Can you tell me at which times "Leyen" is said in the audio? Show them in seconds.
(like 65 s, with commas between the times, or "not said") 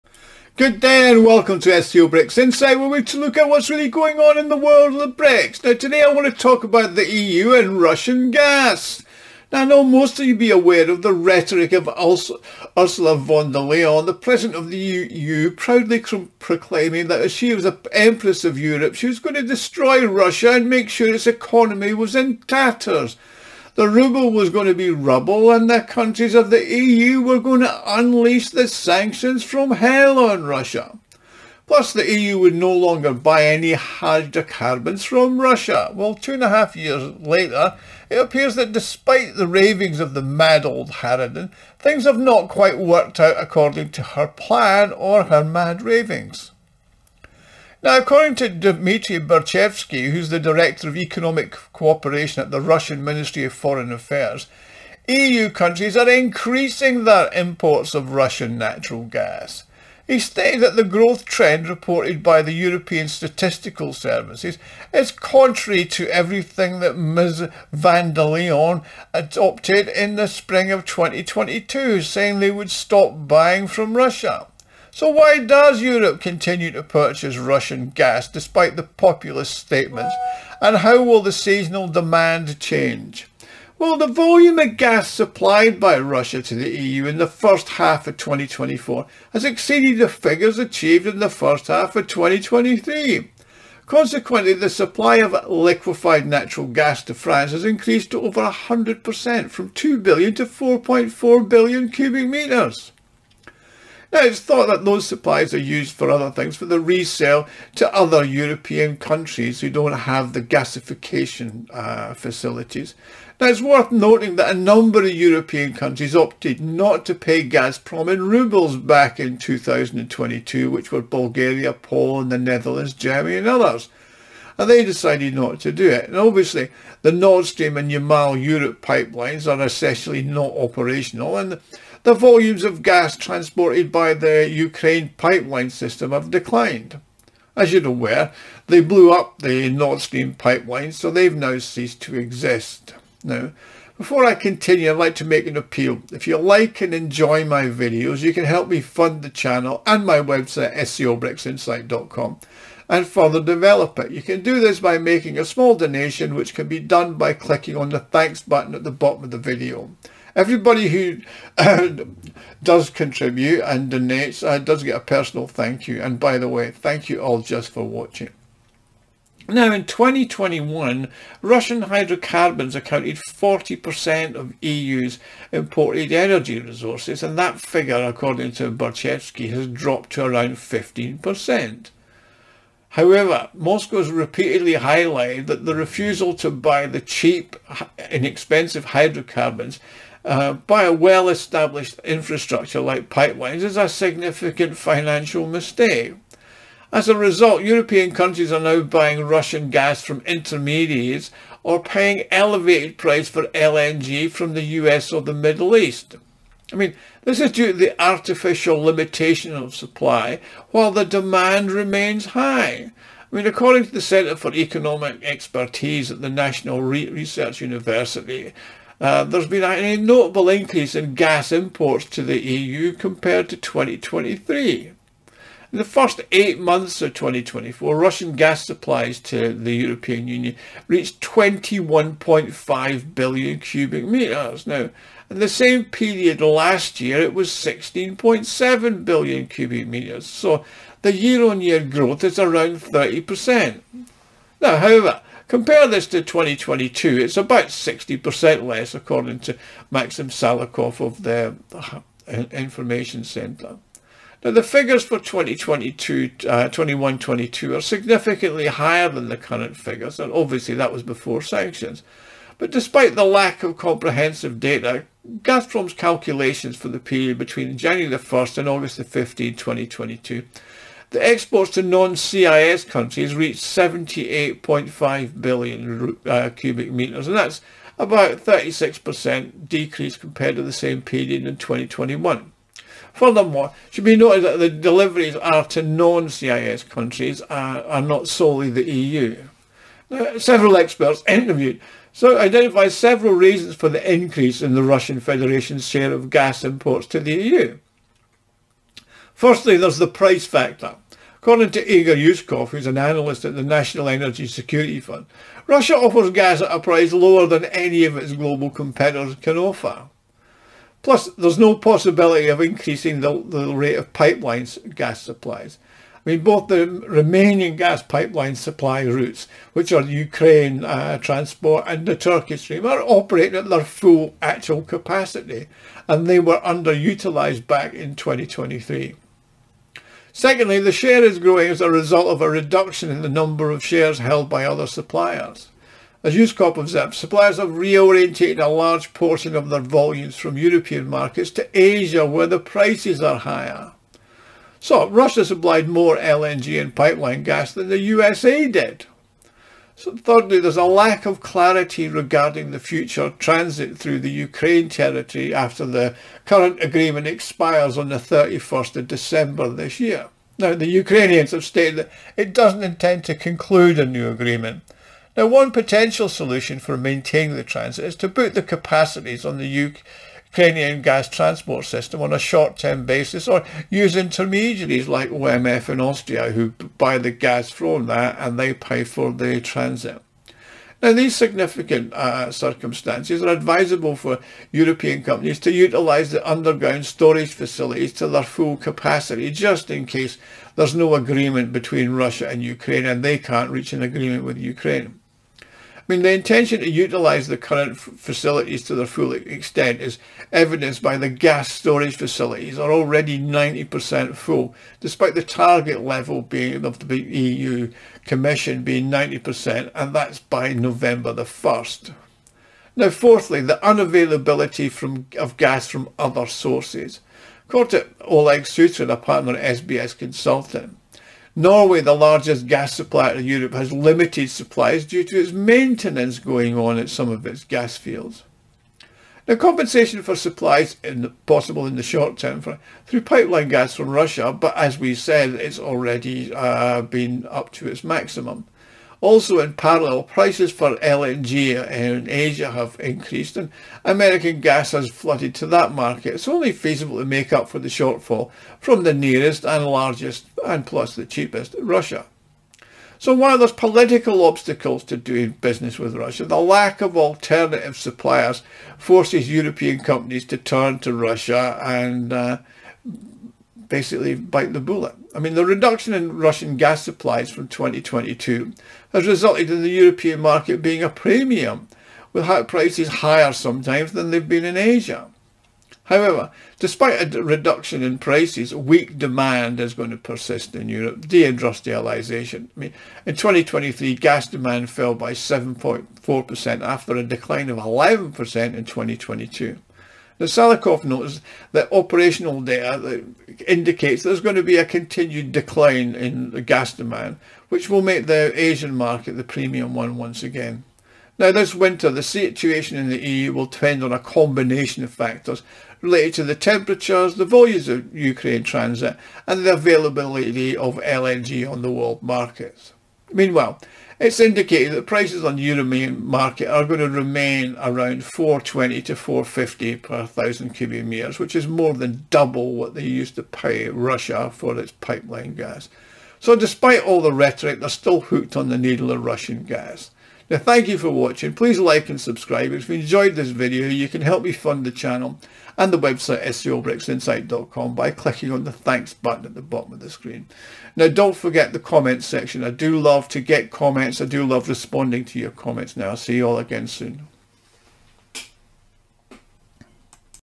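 13 s, 68 s.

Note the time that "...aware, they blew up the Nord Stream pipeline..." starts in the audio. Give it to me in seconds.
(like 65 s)
137 s.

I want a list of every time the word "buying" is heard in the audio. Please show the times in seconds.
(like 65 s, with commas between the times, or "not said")
73 s, 198 s.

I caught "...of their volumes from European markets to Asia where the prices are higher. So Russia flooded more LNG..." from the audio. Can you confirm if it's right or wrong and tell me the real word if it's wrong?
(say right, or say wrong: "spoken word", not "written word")
wrong: "supplied", not "flooded".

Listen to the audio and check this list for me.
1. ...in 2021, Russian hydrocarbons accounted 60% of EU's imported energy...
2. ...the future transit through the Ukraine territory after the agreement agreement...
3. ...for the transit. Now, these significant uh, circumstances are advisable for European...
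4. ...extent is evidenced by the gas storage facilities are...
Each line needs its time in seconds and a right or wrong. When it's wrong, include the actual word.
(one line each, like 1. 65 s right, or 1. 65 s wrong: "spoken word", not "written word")
1. 169 s wrong: "40", not "60"
2. 352 s wrong: "current", not "agreement"
3. 379 s right
4. 399 s right.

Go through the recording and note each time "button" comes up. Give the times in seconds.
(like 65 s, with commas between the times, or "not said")
158 s, 539 s.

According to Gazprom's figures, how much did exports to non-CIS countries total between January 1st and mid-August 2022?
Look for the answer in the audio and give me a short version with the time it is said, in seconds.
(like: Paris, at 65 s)
78.5 billion cubic metres, at 273 s.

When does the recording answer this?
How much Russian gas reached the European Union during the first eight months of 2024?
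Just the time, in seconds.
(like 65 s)
231 s.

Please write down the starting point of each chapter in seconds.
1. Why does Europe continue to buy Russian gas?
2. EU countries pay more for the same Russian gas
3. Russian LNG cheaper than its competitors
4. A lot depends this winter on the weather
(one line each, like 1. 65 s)
1. 75 s
2. 195 s
3. 303 s
4. 512 s.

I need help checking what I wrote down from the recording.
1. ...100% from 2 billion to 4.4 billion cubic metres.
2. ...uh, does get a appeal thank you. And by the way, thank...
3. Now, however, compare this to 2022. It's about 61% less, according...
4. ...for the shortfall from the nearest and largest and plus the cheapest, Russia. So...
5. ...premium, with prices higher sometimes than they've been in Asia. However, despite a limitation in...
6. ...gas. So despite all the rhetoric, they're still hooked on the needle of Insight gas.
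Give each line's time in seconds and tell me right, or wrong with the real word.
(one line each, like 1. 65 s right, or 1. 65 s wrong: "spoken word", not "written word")
1. 98 s right
2. 164 s wrong: "personal", not "appeal"
3. 244 s wrong: "60", not "61"
4. 447 s right
5. 471 s wrong: "reduction", not "limitation"
6. 525 s wrong: "Russian", not "Insight".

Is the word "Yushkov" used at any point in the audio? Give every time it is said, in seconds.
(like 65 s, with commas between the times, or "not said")
302 s, 336 s.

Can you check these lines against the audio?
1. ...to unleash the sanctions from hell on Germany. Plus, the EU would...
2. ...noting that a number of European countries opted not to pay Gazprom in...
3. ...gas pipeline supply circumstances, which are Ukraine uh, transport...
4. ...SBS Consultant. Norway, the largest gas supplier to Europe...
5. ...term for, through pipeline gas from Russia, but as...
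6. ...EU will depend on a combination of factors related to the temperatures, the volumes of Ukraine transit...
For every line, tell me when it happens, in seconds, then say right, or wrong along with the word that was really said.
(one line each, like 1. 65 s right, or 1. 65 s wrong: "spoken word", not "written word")
1. 27 s wrong: "Russia", not "Germany"
2. 113 s right
3. 317 s wrong: "routes", not "circumstances"
4. 419 s right
5. 432 s right
6. 503 s right.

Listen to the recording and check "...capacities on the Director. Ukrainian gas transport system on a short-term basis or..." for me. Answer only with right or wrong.
wrong.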